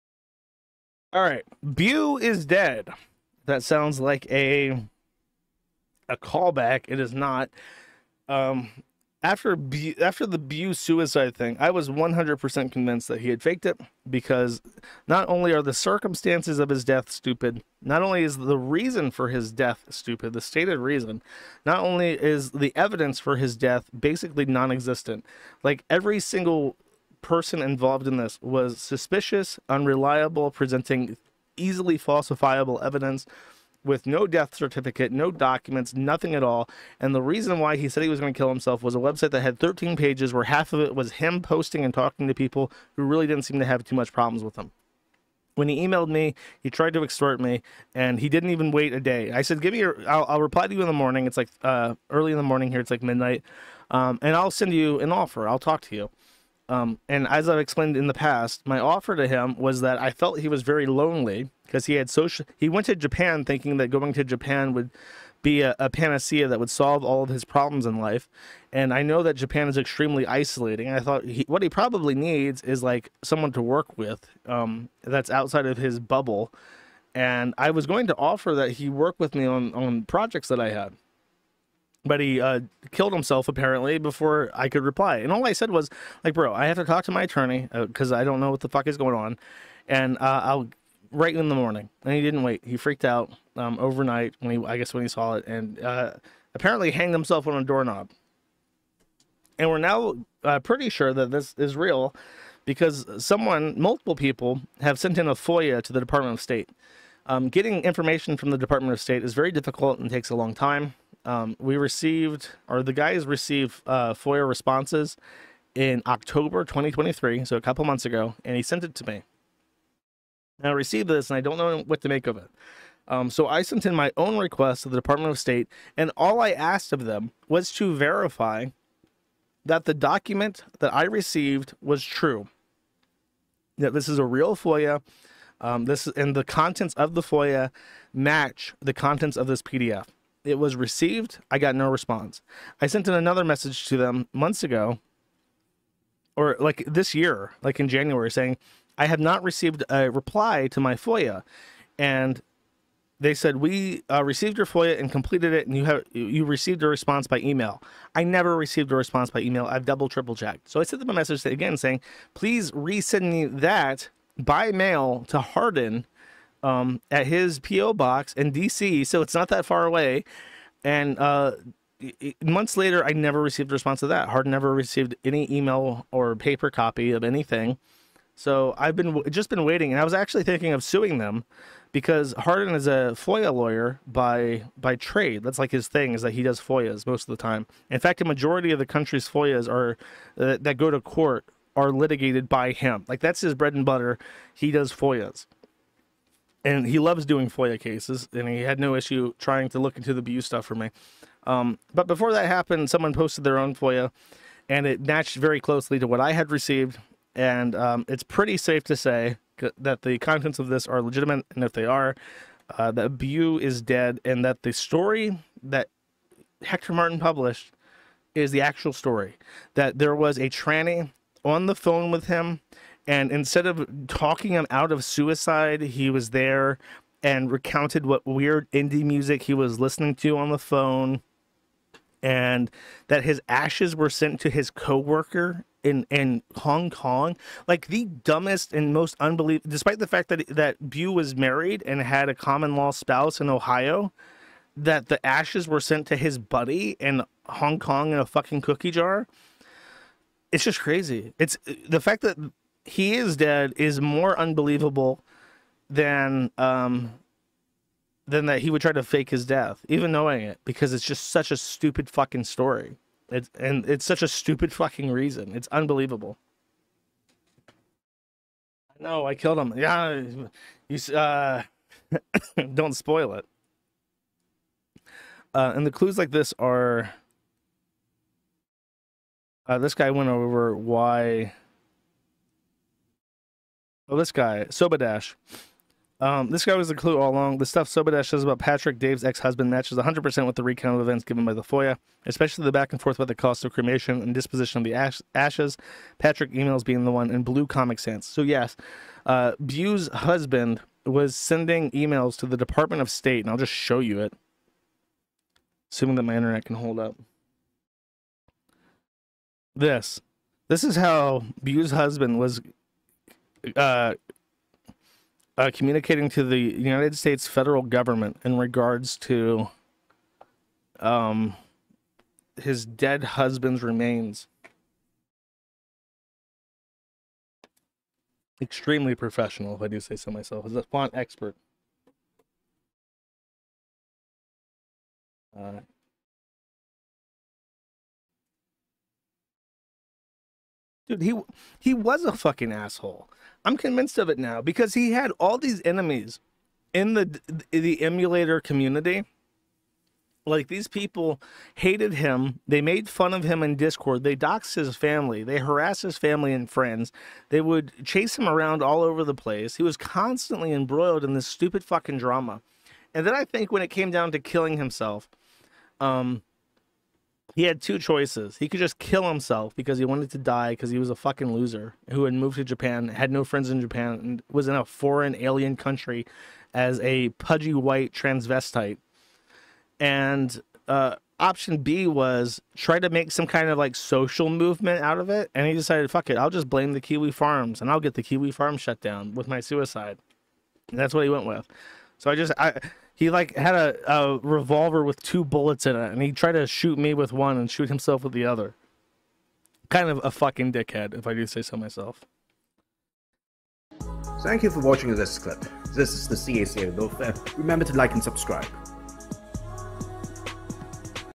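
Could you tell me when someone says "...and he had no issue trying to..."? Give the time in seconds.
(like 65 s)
198 s.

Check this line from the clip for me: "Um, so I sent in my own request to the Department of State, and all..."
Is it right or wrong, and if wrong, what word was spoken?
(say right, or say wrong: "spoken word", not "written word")
right.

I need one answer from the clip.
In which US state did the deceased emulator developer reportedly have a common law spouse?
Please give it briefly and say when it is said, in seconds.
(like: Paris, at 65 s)
Ohio, at 243 s.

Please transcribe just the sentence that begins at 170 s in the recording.
And uh, months later, I never received a response to that.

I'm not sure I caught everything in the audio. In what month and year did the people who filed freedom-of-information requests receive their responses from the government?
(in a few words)
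October 2023.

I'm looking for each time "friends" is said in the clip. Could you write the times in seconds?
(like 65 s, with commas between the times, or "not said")
356 s, 373 s.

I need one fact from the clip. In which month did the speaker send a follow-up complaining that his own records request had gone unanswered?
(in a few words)
January.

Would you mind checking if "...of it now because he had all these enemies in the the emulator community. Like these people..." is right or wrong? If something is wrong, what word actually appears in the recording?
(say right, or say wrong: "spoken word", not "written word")
right.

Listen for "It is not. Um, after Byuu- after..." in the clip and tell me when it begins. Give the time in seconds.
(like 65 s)
6 s.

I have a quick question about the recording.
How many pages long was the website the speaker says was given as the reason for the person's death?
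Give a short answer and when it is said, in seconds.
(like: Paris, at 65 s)
13, at 39 s.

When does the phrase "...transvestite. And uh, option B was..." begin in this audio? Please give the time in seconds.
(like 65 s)
378 s.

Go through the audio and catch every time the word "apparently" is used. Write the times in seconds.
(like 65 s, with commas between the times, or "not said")
83 s, 96 s.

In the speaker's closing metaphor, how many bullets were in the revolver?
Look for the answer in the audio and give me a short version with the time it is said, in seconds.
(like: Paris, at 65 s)
2, at 395 s.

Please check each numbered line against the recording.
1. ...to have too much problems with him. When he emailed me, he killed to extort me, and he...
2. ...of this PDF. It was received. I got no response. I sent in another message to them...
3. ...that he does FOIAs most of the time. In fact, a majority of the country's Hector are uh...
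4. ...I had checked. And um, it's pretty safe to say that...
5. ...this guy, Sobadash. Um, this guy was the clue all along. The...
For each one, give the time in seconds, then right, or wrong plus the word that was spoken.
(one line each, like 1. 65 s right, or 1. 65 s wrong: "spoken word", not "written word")
1. 43 s wrong: "tried", not "killed"
2. 139 s right
3. 186 s wrong: "FOIAs", not "Hector"
4. 206 s wrong: "received", not "checked"
5. 284 s right.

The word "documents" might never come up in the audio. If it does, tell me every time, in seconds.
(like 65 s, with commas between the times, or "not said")
35 s, 129 s.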